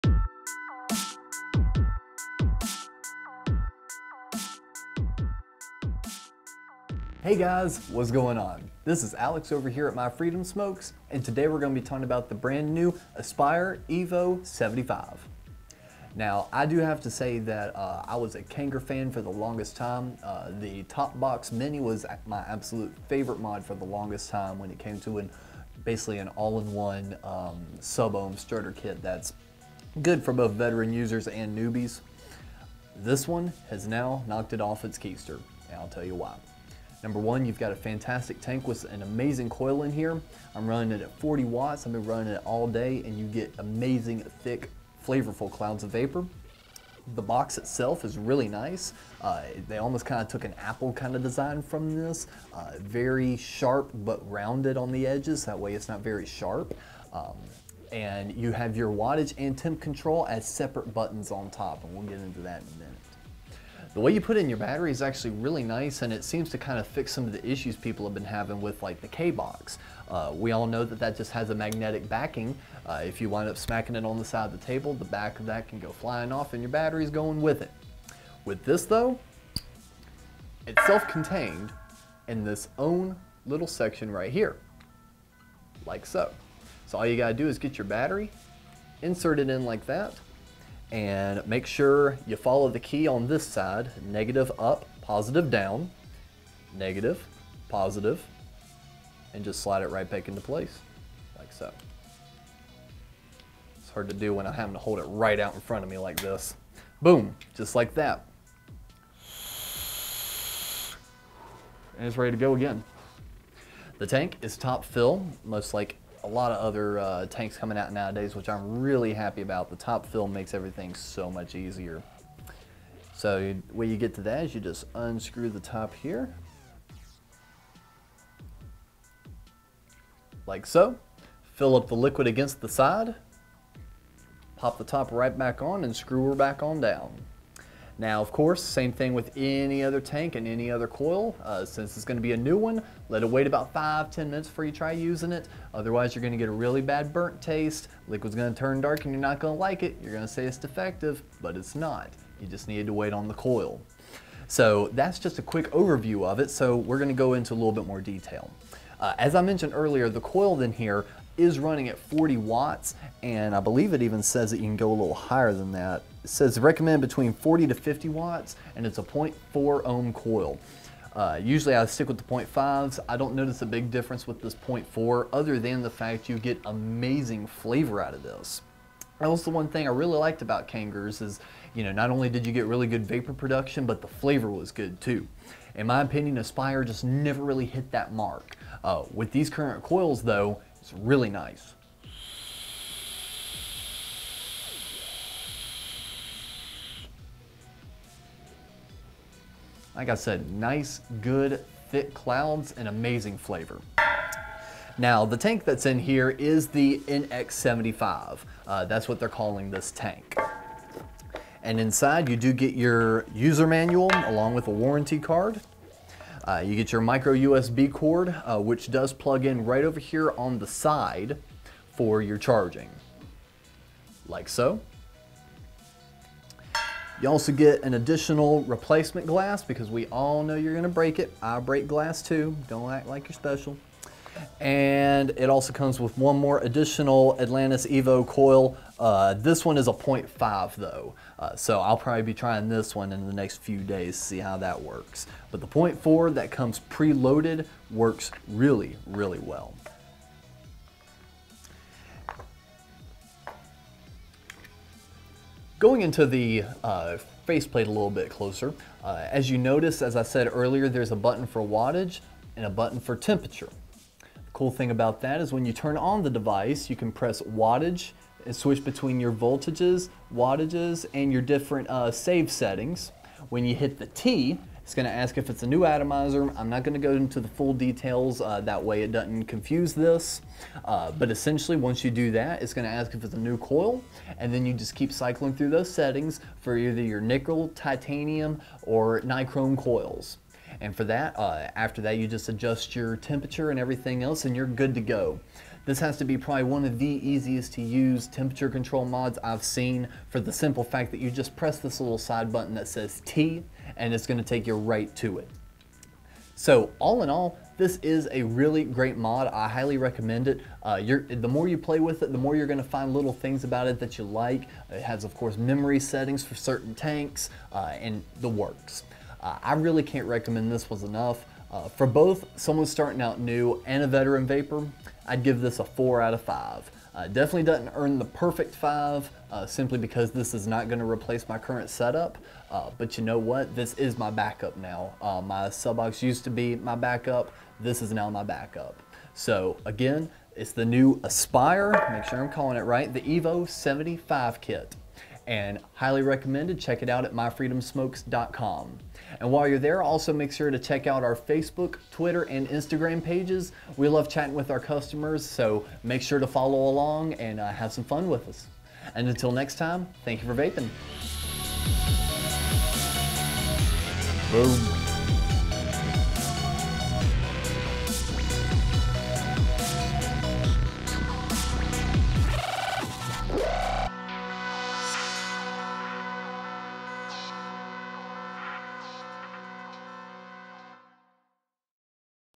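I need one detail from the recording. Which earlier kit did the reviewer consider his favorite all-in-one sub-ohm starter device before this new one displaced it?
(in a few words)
Top Box Mini.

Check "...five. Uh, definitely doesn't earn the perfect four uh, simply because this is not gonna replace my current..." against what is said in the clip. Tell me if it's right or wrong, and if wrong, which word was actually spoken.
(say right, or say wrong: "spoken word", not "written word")
wrong: "five", not "four".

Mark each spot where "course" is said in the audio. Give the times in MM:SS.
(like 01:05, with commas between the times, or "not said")
02:18, 05:15.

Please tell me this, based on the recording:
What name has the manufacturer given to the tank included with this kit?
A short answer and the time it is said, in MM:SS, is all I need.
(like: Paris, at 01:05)
NX75, at 03:27.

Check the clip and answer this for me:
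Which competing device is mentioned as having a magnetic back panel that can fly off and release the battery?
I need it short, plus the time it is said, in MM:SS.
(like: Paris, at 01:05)
K-Box, at 01:09.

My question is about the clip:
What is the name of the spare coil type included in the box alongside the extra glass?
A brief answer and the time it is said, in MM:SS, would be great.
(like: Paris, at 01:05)
Atlantis Evo, at 03:57.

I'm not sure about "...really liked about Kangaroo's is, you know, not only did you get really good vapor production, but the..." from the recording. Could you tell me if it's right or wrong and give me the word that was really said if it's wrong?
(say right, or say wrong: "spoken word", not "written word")
right.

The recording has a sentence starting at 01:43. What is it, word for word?
It's hard to do when I'm having to hold it right out in front of me like this.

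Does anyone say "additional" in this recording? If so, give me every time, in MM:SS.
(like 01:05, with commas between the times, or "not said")
03:47, 03:56.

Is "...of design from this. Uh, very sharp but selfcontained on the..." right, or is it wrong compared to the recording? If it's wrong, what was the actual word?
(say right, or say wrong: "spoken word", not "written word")
wrong: "rounded", not "selfcontained".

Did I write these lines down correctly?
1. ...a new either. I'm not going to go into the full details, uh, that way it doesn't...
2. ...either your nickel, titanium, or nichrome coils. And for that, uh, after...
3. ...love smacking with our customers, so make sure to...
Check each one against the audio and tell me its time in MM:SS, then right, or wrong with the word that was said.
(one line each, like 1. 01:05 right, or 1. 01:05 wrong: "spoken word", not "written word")
1. 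04:35 wrong: "atomizer", not "either"
2. 04:46 right
3. 05:54 wrong: "chatting", not "smacking".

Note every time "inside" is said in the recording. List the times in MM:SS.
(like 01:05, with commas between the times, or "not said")
03:31.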